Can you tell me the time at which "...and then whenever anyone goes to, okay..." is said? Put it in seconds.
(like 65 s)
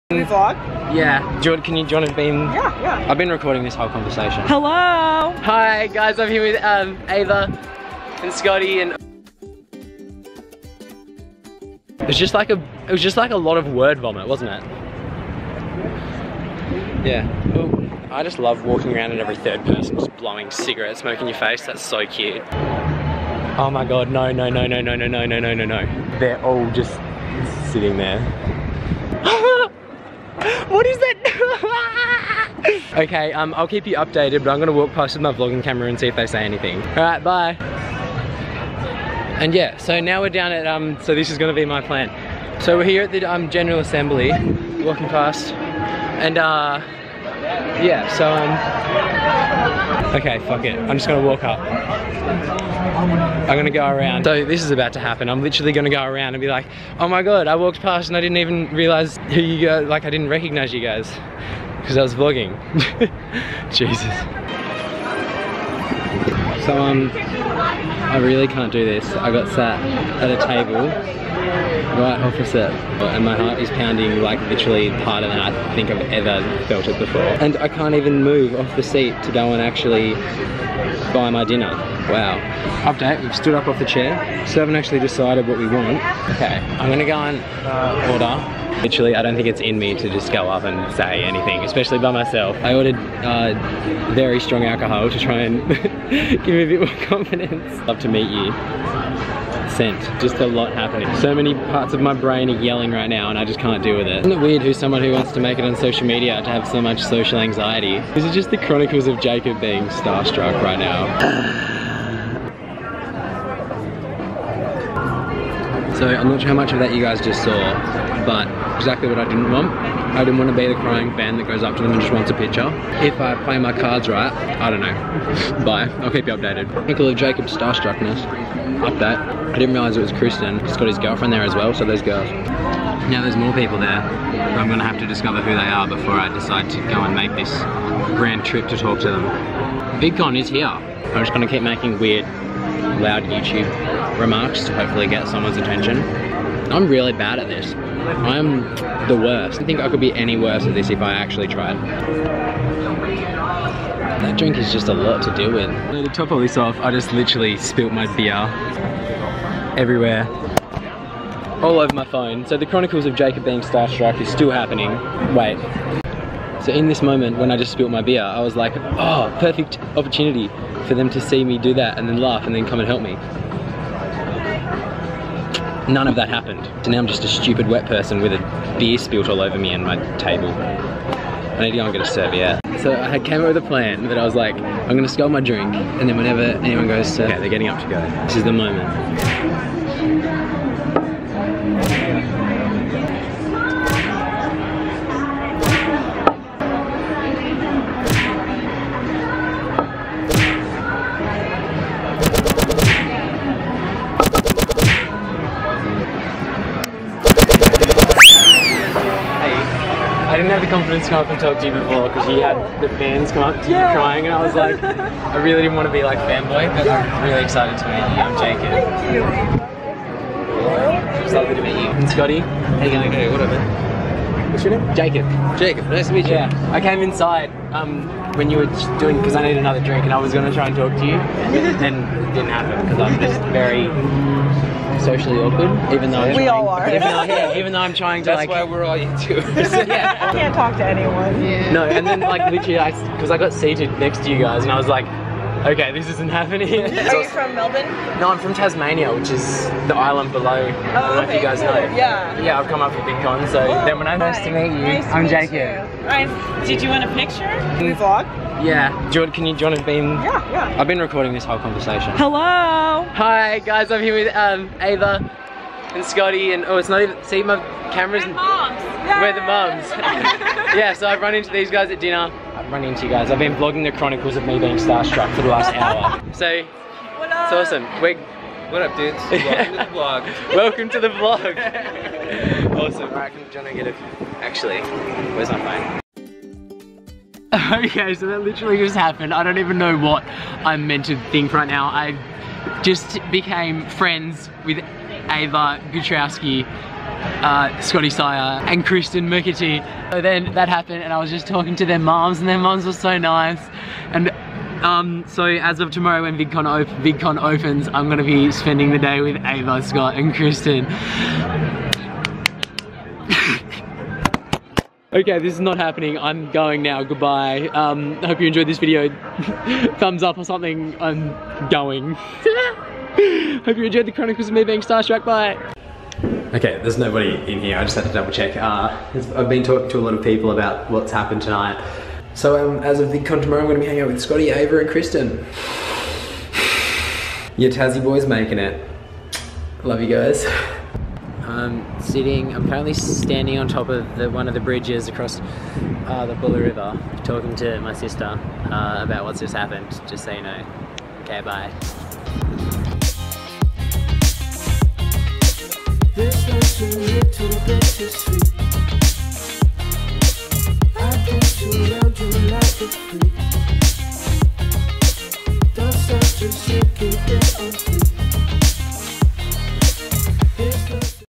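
185 s.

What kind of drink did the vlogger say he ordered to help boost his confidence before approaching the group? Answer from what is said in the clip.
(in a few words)
very strong alcohol.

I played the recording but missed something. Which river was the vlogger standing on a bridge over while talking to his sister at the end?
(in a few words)
Buller River.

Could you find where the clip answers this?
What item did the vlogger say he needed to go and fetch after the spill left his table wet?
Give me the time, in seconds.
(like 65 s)
182 s.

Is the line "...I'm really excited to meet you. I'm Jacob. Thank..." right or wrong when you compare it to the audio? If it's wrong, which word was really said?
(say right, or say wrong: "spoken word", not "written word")
right.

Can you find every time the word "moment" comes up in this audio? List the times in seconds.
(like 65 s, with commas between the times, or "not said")
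167 s, 188 s.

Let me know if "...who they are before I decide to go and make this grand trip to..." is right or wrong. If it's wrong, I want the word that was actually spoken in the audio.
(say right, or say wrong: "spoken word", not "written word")
right.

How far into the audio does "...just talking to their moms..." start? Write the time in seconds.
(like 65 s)
301 s.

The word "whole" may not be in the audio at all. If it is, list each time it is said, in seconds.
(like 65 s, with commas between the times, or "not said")
3 s, 261 s.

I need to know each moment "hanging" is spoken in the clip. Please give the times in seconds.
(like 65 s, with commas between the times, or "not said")
333 s.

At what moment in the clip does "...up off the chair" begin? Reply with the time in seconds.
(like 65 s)
83 s.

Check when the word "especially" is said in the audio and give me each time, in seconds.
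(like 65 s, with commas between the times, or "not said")
91 s.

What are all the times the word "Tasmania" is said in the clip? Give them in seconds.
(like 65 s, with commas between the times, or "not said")
248 s.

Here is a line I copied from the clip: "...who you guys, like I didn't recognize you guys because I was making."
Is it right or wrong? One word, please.
wrong.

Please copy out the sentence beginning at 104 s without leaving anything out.
Isn't it weird who's someone who wants to make it on social media to have so much social anxiety?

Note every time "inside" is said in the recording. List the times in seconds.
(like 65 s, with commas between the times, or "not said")
227 s.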